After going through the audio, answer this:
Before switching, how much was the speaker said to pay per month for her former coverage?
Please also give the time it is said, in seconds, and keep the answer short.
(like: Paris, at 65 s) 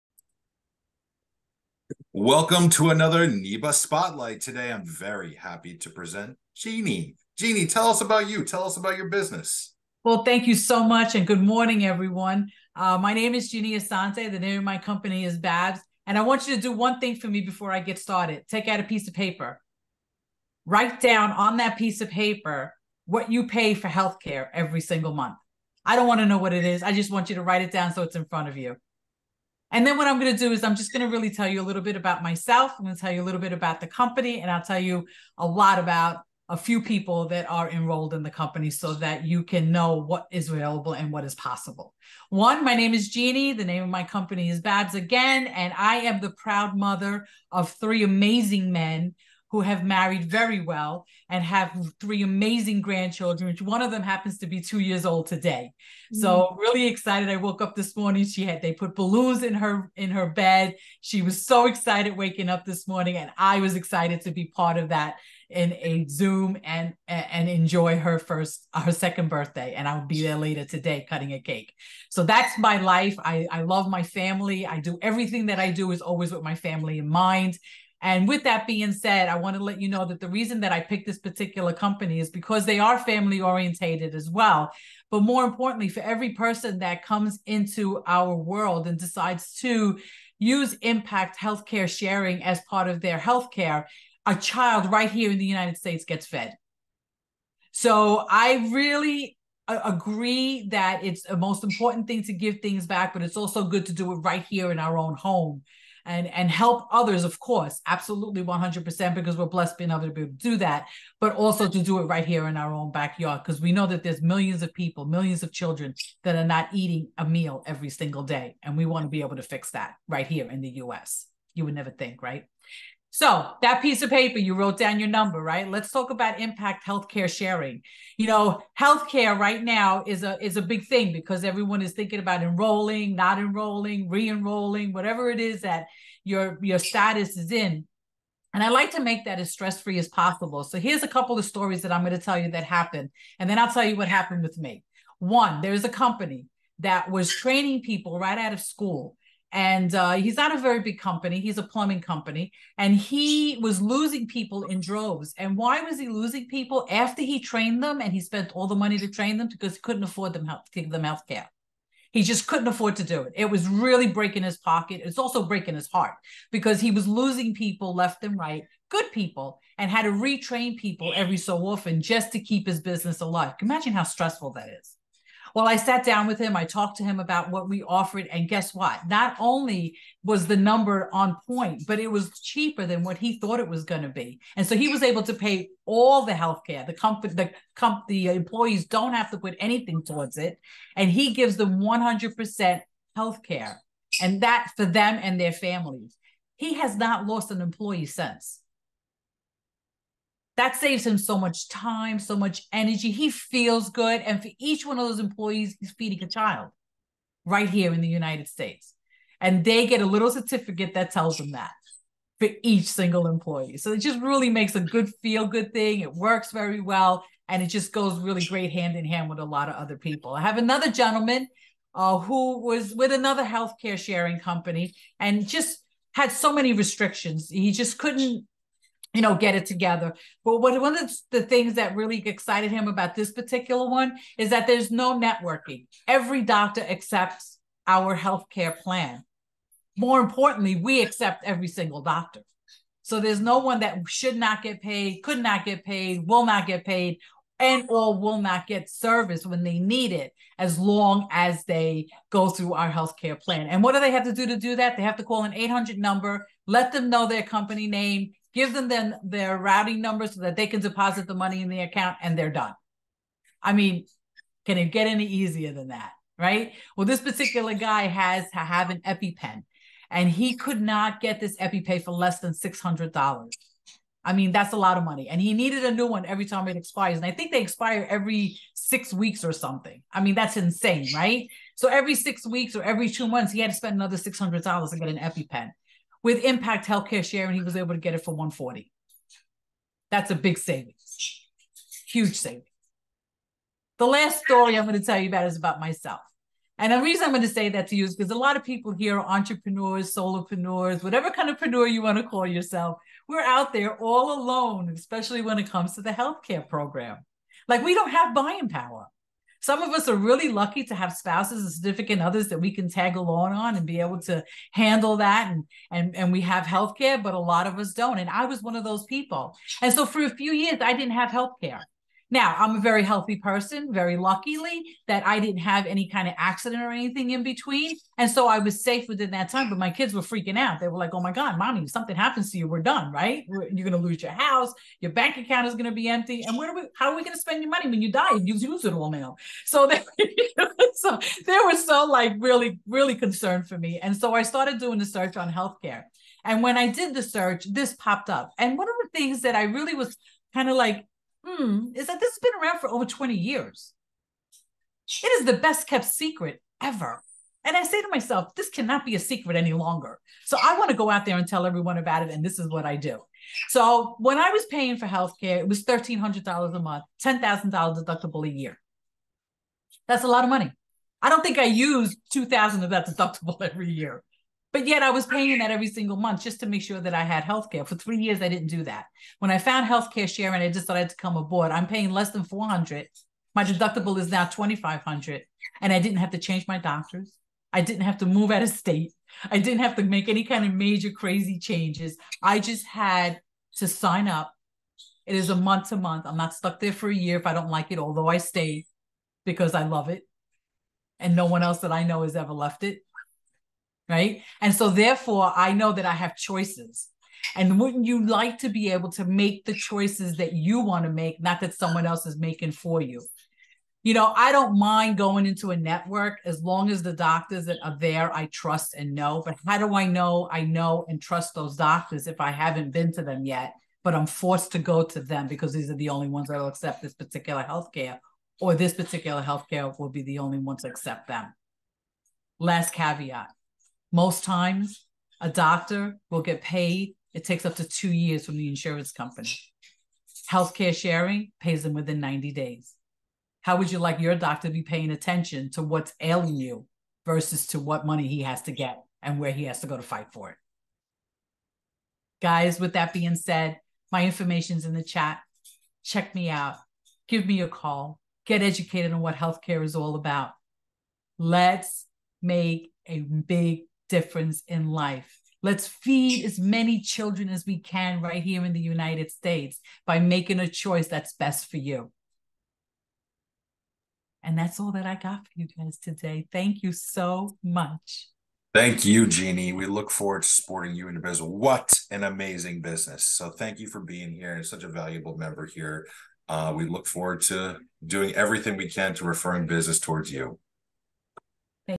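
$1,300, at 365 s.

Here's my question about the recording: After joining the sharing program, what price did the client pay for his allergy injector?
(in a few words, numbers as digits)
140.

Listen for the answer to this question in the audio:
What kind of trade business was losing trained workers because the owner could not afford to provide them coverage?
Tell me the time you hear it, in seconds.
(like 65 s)
151 s.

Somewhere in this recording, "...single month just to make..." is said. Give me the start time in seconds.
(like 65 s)
375 s.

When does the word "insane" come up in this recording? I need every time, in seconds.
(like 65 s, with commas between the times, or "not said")
280 s.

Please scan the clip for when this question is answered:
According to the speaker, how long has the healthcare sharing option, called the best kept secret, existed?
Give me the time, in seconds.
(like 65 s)
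352 s.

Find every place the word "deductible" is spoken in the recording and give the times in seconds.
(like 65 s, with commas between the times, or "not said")
367 s, 373 s, 383 s.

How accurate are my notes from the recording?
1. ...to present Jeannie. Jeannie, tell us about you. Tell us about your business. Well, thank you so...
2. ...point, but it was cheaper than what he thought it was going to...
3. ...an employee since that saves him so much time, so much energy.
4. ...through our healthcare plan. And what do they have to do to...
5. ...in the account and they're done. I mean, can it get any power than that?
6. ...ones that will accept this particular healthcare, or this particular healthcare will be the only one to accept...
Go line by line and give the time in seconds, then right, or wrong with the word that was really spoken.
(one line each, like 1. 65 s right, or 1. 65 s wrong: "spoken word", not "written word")
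1. 5 s right
2. 181 s right
3. 197 s right
4. 252 s right
5. 261 s wrong: "easier", not "power"
6. 426 s right.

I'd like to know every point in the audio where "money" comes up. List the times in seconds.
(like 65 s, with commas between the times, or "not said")
158 s, 261 s, 275 s, 337 s, 370 s, 448 s.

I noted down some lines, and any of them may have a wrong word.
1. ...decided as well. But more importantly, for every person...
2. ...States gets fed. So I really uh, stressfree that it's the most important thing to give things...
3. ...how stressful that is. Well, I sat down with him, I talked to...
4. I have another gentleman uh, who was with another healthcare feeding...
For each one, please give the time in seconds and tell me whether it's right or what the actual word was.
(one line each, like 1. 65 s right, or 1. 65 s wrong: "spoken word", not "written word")
1. 83 s wrong: "orientated", not "decided"
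2. 95 s wrong: "agree", not "stressfree"
3. 173 s right
4. 220 s wrong: "sharing", not "feeding".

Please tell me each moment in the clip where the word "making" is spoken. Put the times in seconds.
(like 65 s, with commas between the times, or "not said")
412 s, 470 s.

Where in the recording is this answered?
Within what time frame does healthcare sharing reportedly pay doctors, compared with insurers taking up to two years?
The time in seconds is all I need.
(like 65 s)
442 s.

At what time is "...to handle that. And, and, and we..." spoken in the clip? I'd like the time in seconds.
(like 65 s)
314 s.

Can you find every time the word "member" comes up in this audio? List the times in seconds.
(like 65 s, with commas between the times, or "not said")
485 s.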